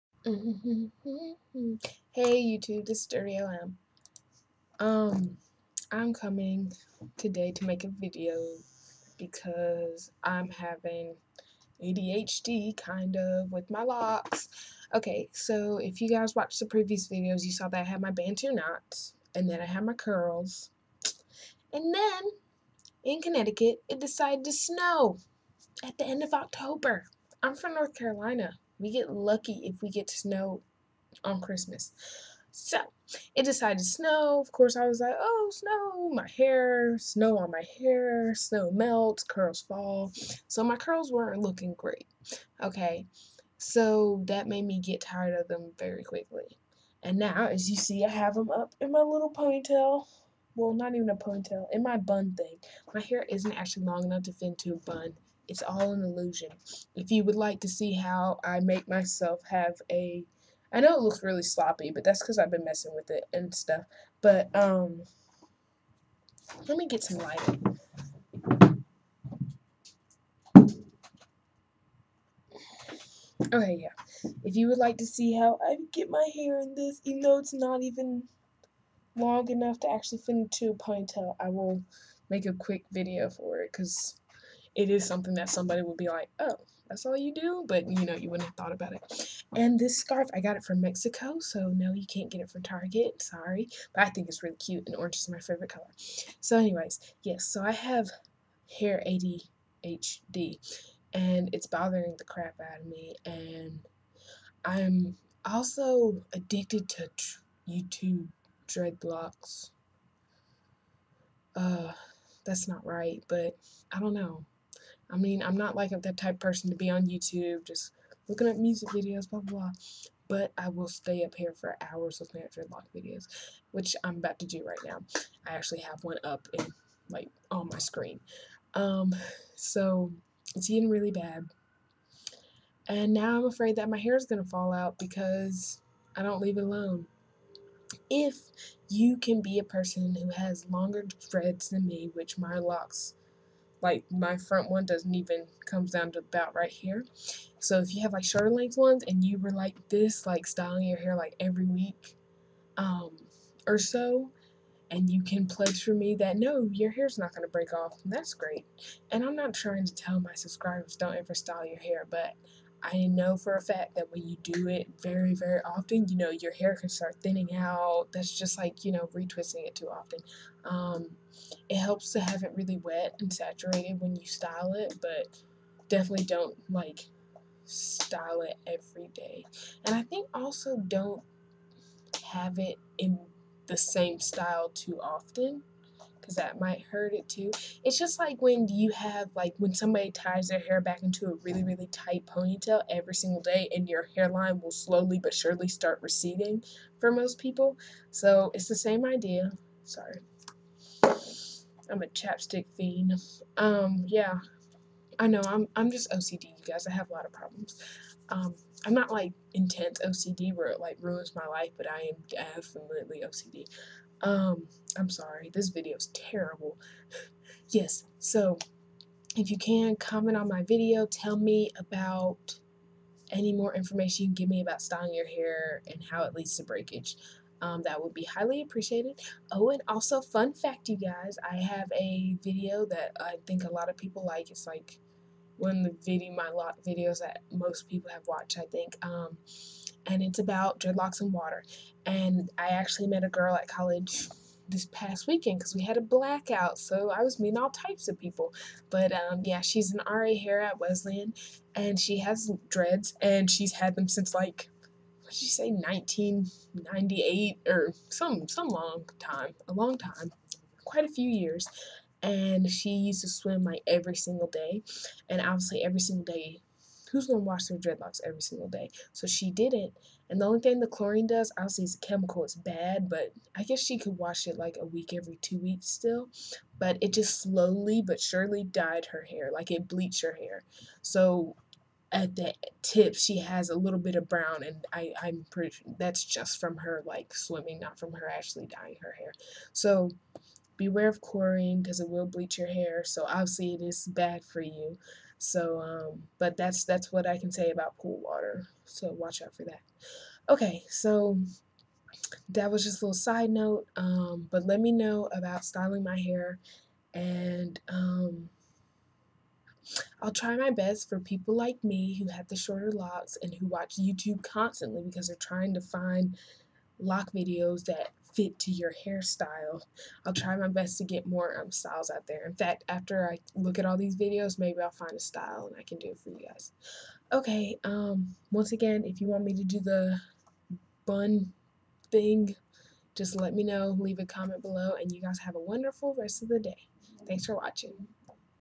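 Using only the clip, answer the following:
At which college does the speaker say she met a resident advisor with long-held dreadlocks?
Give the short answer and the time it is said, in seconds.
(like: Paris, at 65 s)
Wesleyan, at 250 s.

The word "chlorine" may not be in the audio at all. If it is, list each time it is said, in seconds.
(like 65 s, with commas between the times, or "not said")
270 s, 291 s.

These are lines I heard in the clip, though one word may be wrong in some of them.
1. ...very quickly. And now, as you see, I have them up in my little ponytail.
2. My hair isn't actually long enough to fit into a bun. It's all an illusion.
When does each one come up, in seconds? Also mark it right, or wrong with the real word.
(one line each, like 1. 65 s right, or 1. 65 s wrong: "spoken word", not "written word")
1. 45 s right
2. 52 s right.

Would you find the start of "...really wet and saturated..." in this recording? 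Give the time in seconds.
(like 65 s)
172 s.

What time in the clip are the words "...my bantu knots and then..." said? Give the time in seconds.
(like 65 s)
18 s.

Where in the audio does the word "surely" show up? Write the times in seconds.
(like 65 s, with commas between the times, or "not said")
195 s, 278 s.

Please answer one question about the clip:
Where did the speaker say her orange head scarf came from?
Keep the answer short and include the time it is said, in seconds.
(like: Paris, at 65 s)
Mexico, at 90 s.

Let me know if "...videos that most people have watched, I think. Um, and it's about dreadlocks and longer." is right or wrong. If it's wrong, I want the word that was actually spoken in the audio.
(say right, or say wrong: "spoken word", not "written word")
wrong: "water", not "longer".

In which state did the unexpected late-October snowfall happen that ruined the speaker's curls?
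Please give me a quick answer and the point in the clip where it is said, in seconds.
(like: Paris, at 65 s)
Connecticut, at 23 s.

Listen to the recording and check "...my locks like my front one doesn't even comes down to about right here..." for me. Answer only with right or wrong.
right.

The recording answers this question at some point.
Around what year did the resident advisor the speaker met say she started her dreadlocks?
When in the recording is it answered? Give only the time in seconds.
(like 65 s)
255 s.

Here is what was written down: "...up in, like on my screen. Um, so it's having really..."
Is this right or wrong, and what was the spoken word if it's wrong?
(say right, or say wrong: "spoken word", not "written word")
wrong: "getting", not "having".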